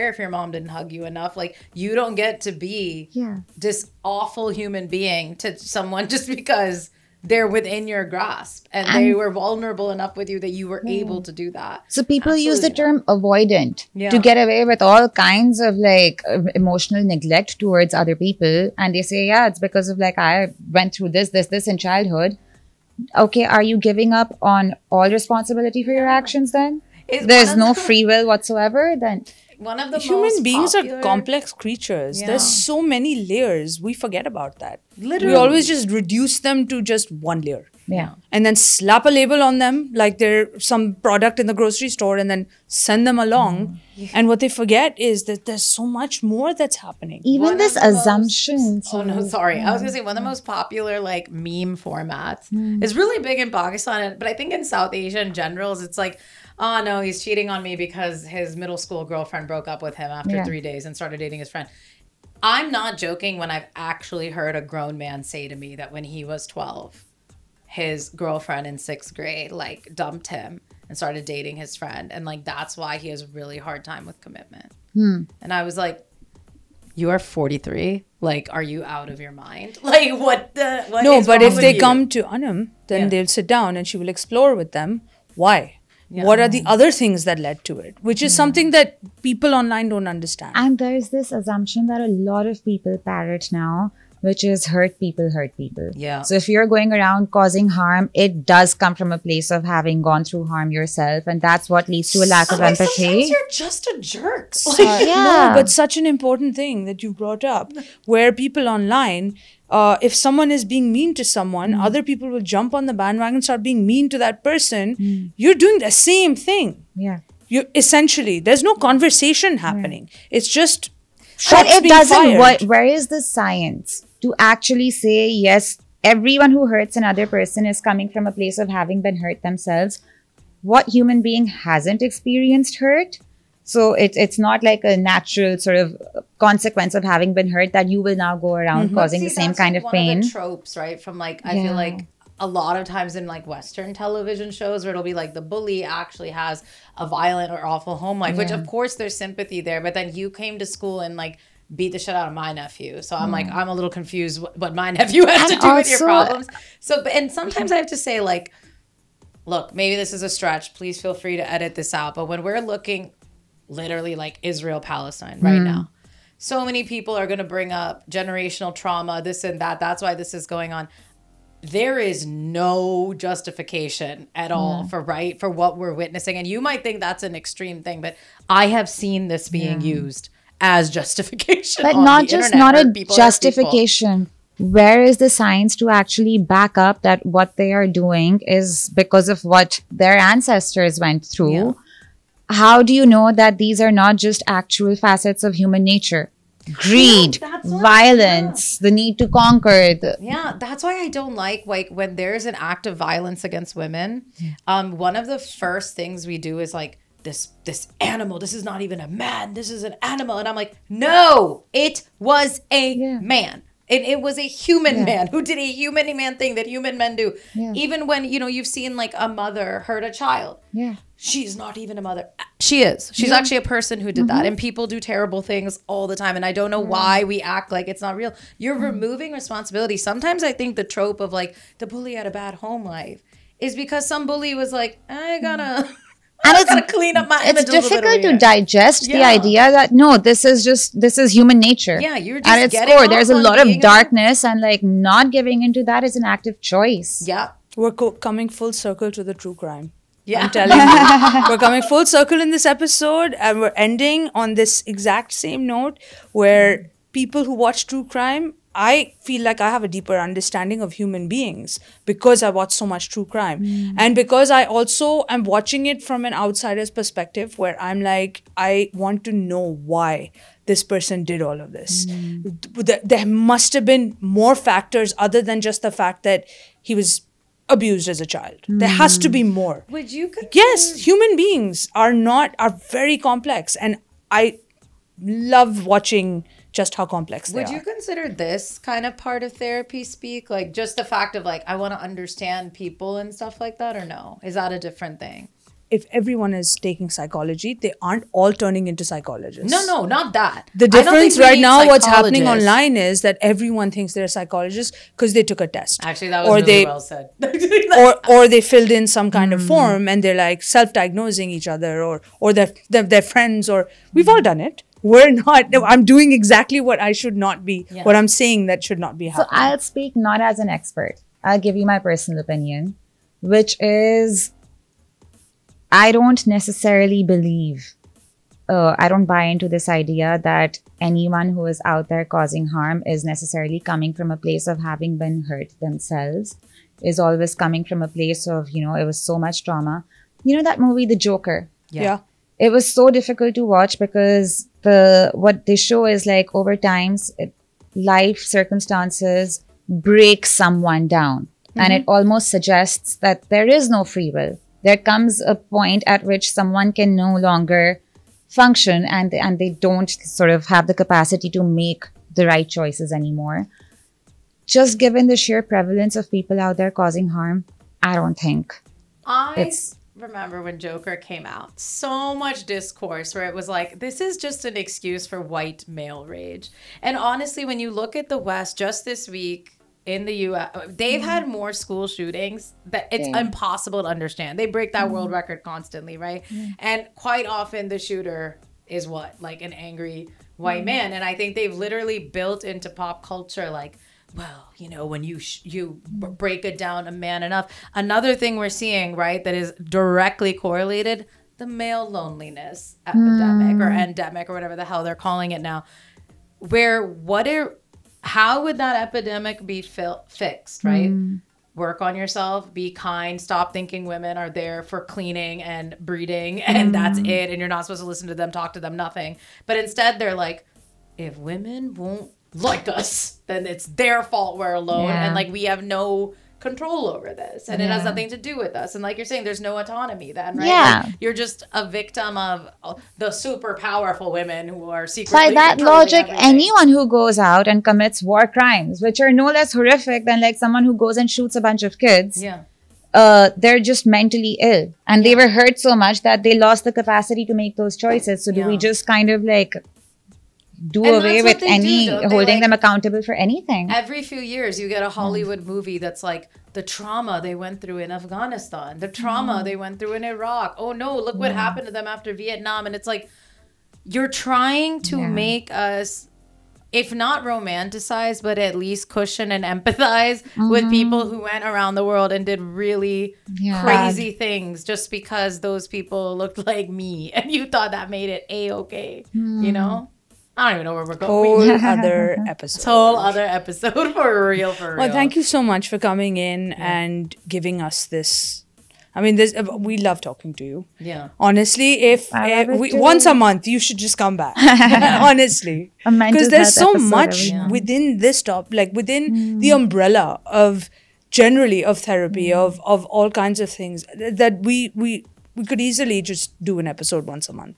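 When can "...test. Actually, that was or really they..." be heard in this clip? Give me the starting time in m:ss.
5:05.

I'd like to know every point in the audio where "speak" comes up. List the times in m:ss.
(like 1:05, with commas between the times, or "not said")
4:50, 5:19.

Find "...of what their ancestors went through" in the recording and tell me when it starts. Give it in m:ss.
3:09.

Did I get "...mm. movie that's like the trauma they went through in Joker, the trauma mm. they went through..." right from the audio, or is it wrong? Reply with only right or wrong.
wrong.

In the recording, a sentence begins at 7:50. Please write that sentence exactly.
with people who went around the world and did really yeah.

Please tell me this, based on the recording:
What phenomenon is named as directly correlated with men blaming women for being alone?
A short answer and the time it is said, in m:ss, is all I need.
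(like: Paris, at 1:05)
Male loneliness epidemic, at 6:41.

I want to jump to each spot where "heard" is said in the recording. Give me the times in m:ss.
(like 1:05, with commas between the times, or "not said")
1:04.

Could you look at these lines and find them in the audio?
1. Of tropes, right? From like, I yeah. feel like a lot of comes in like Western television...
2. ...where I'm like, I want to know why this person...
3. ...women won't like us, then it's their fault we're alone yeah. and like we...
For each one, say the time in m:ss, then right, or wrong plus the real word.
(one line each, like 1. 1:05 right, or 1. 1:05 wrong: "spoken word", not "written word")
1. 2:20 wrong: "times", not "comes"
2. 4:27 right
3. 7:01 right.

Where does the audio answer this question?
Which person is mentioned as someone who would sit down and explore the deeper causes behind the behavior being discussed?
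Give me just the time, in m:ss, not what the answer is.
1:22.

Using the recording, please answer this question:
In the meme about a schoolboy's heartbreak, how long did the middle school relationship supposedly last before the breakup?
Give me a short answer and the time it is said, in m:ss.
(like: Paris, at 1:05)
3 days, at 1:00.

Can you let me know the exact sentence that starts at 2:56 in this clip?
And you might think that's an extreme thing, but I have seen this being yeah.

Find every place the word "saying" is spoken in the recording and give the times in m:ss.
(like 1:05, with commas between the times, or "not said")
5:18, 7:09.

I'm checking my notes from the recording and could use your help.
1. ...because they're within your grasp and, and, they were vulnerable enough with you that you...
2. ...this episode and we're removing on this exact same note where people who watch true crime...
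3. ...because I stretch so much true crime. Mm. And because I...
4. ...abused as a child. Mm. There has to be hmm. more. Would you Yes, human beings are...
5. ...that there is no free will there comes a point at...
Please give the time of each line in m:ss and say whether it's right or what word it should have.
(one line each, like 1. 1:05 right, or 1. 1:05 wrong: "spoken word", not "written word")
1. 0:06 right
2. 4:12 wrong: "ending", not "removing"
3. 4:22 wrong: "watch", not "stretch"
4. 4:37 right
5. 5:53 right.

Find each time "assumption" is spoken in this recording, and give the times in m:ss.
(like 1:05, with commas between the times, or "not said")
0:47, 1:31.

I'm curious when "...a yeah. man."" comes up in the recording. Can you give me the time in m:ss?
3:32.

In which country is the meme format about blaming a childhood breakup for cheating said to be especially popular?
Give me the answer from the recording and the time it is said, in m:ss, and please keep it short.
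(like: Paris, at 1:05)
Pakistan, at 0:53.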